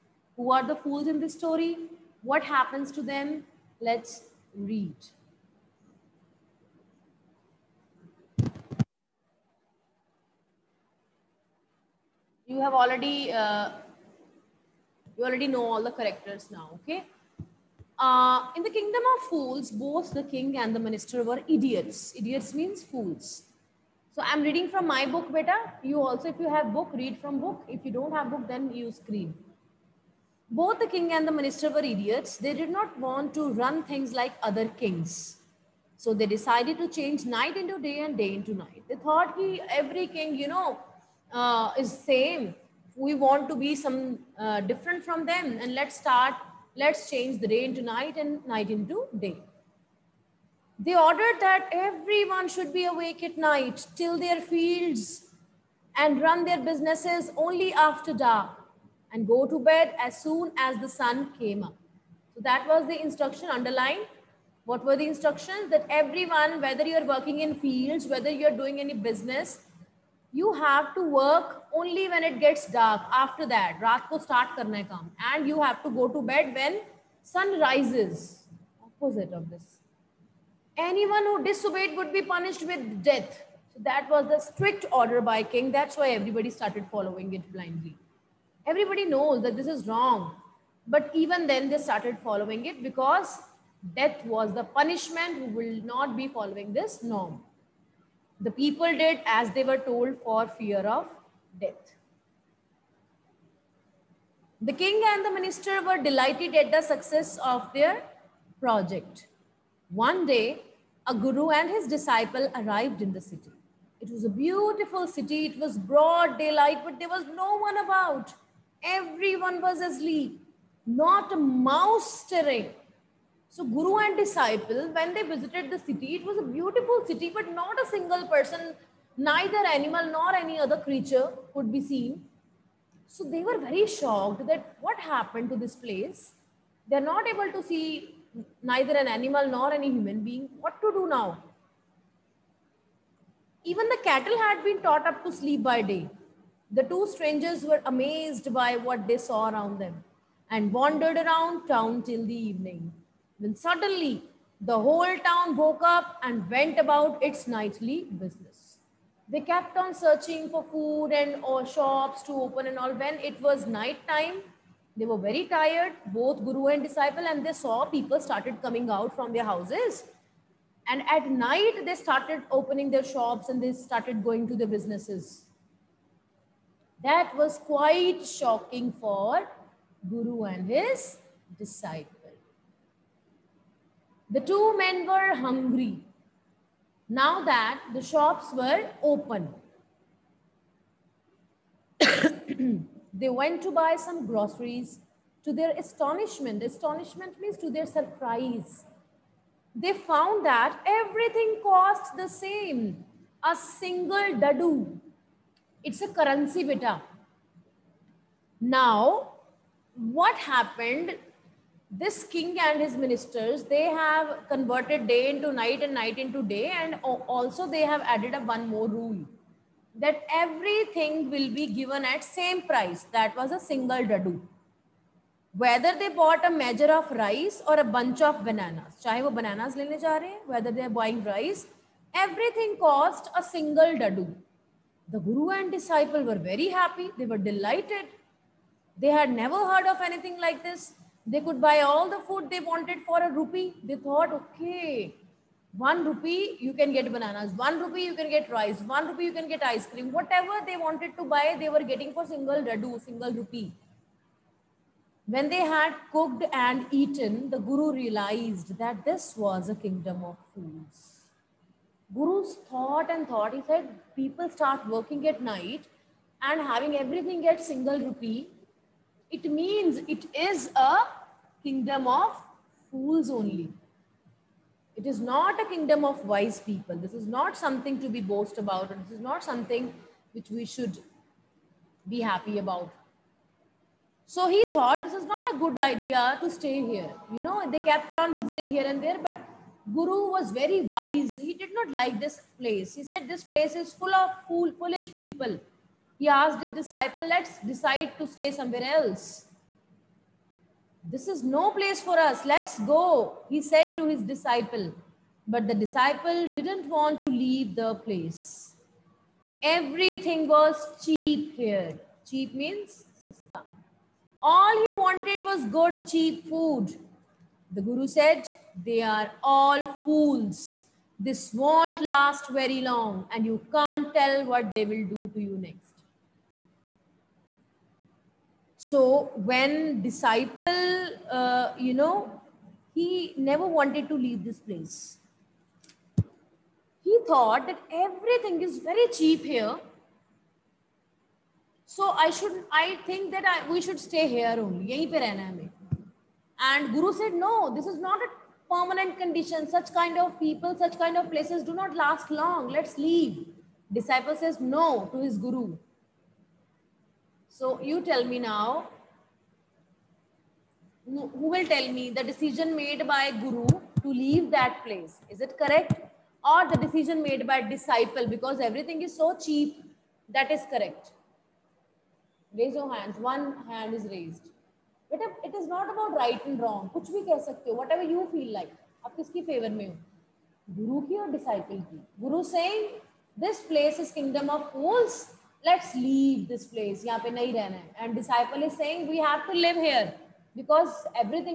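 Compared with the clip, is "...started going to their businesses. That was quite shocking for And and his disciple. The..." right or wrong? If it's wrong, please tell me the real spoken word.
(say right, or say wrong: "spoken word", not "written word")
wrong: "Guru", not "And".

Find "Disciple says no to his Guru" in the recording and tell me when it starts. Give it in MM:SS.
05:53.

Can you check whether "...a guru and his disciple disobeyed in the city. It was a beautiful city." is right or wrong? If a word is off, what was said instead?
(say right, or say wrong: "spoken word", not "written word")
wrong: "arrived", not "disobeyed".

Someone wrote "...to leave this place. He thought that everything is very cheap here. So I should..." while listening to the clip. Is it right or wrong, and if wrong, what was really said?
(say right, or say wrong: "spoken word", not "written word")
right.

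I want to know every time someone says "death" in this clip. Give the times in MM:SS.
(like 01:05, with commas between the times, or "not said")
01:23, 01:33, 01:41.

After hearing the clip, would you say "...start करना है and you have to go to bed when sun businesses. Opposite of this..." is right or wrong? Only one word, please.
wrong.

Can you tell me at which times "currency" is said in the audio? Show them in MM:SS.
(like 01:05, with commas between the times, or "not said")
03:26.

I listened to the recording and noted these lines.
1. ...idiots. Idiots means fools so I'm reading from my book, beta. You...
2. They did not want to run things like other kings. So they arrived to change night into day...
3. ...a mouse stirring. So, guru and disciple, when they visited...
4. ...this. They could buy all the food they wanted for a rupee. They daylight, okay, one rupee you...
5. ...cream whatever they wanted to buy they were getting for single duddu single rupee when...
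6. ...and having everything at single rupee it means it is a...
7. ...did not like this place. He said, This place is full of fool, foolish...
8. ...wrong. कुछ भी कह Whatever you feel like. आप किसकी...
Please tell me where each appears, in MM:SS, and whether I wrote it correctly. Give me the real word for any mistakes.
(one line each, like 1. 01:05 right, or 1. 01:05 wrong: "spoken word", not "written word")
1. 00:21 right
2. 00:32 wrong: "decided", not "arrived"
3. 02:01 right
4. 04:00 wrong: "thought", not "daylight"
5. 04:09 right
6. 04:26 right
7. 04:51 right
8. 06:16 right.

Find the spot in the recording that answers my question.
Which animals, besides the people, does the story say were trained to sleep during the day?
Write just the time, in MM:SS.
02:23.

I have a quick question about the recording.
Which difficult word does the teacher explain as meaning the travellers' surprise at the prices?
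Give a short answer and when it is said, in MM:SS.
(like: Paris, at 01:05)
astonishment, at 03:15.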